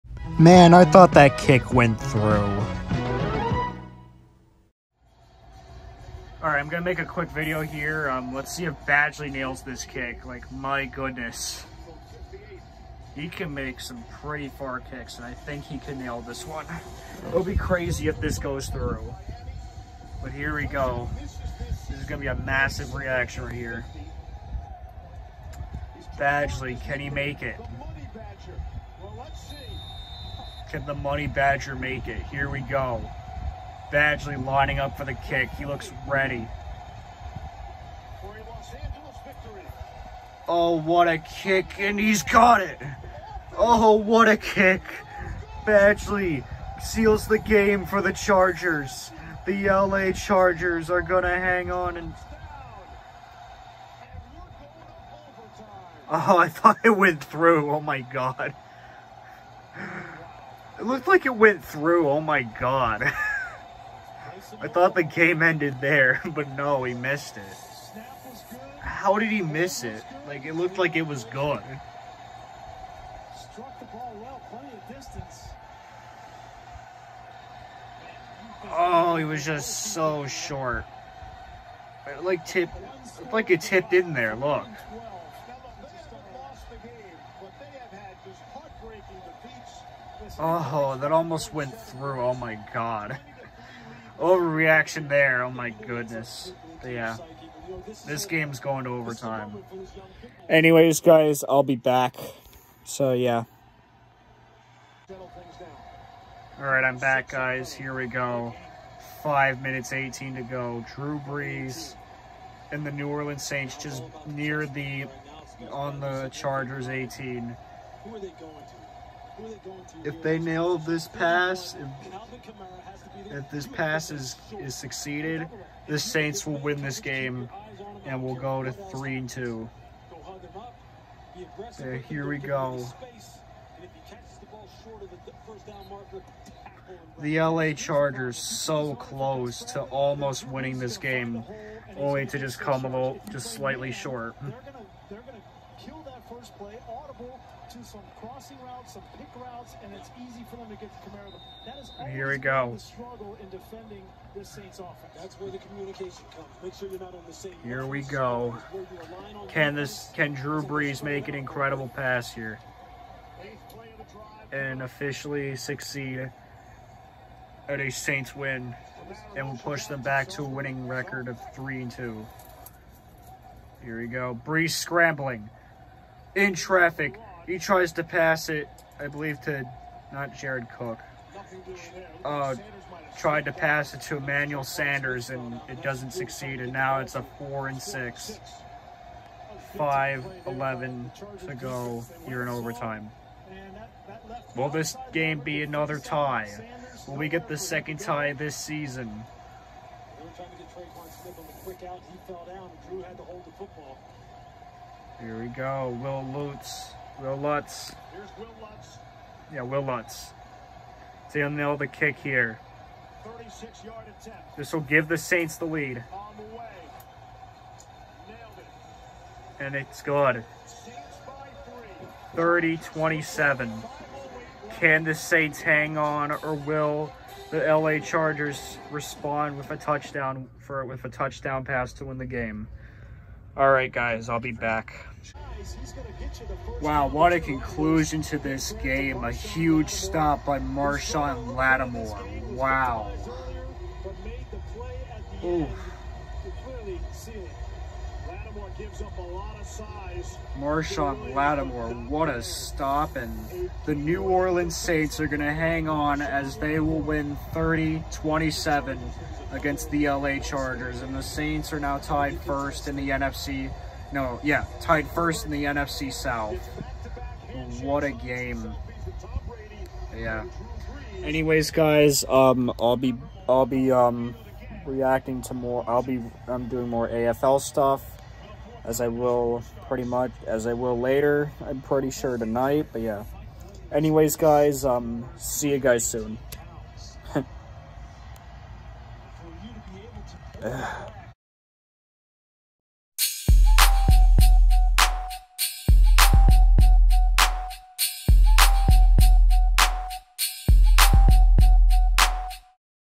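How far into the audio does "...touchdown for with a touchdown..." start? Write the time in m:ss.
3:49.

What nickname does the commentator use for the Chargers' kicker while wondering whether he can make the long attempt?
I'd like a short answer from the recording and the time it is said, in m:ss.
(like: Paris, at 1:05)
Money Badger, at 0:30.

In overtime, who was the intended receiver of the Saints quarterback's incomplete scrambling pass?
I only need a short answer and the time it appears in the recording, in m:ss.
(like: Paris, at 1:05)
Emmanuel Sanders, at 3:04.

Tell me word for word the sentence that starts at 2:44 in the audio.
And officially succeed at a Saints win and will push them back to a winning record of 3 and 2.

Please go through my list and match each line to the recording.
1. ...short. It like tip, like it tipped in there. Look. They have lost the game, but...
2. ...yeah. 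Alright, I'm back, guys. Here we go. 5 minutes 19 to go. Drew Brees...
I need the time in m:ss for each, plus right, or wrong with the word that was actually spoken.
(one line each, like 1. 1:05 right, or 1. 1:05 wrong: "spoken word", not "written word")
1. 1:20 right
2. 1:43 wrong: "18", not "19".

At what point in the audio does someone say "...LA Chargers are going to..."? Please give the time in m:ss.
0:49.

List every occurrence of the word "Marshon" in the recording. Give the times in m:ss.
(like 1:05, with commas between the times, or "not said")
4:00, 4:10.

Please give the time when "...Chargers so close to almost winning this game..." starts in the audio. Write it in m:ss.
2:17.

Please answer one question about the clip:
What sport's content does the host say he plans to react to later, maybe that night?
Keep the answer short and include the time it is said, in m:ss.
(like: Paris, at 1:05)
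AFL, at 4:37.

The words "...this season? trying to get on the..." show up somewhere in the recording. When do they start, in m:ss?
3:18.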